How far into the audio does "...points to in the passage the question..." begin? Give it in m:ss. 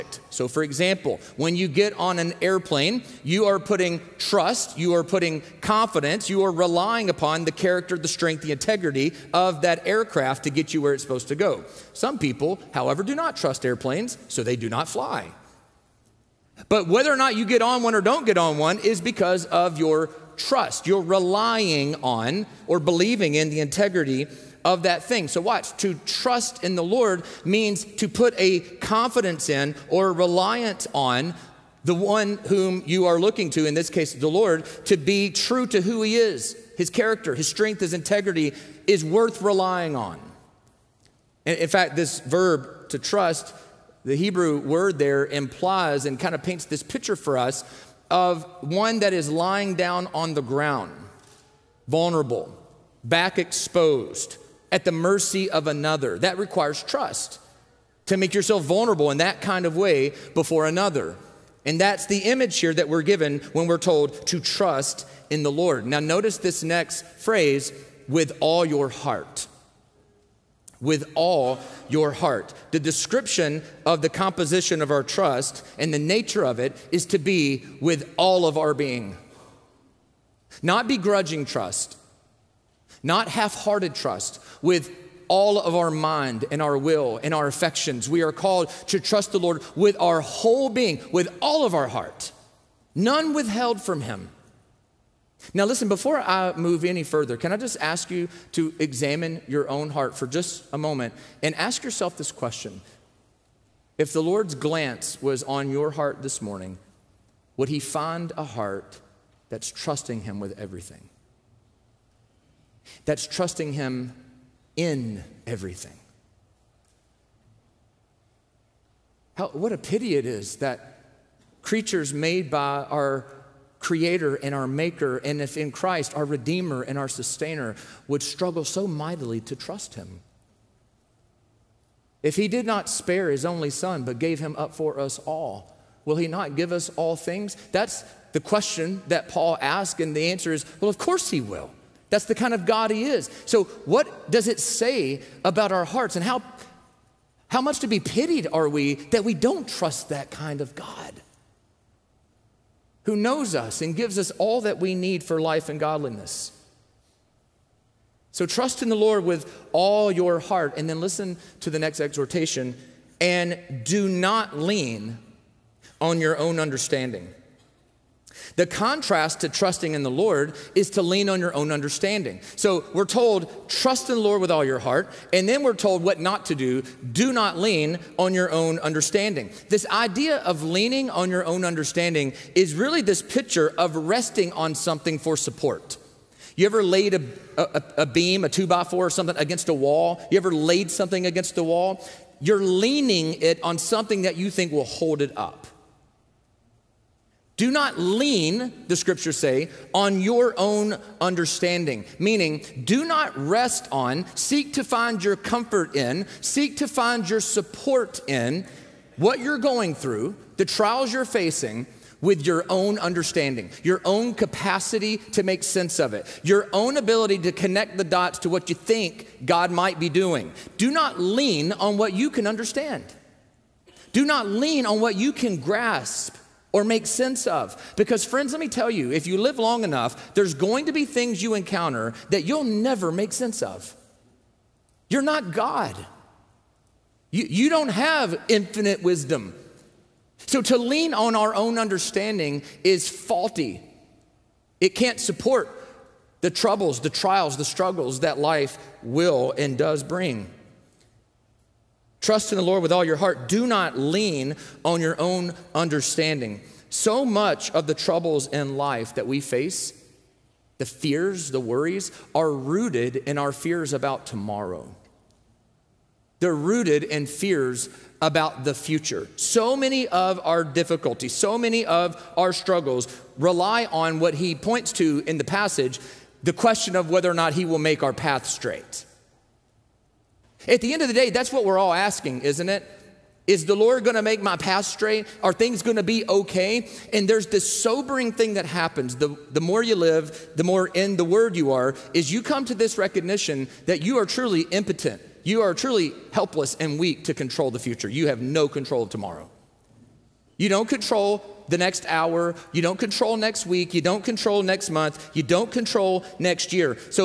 4:34.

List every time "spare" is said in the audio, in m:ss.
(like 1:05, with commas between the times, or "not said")
2:12.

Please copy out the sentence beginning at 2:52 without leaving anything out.
So we're told, trust in the Lord with all your heart, and then we're told what not to do.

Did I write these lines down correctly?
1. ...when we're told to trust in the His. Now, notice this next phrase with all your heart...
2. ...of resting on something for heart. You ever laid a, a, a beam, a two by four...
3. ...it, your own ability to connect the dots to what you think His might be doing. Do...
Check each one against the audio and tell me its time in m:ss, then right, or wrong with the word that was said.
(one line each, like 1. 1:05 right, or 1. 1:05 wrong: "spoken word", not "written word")
1. 1:03 wrong: "Lord", not "His"
2. 3:03 wrong: "support", not "heart"
3. 3:36 wrong: "God", not "His".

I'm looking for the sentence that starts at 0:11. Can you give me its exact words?
Some people, however, do not trust airplanes, so they do not fly.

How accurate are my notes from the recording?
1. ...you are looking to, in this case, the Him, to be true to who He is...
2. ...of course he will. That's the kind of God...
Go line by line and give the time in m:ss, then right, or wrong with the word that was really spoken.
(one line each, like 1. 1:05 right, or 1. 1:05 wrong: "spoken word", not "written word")
1. 0:32 wrong: "Lord", not "Him"
2. 2:20 right.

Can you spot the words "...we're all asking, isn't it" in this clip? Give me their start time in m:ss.
4:41.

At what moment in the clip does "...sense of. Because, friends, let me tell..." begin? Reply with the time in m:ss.
3:47.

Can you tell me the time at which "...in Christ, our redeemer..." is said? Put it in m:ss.
2:05.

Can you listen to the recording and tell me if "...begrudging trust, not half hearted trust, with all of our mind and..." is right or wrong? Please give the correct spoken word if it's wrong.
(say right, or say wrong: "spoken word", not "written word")
right.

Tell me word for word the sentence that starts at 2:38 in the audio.
So trust in the Lord with all your heart.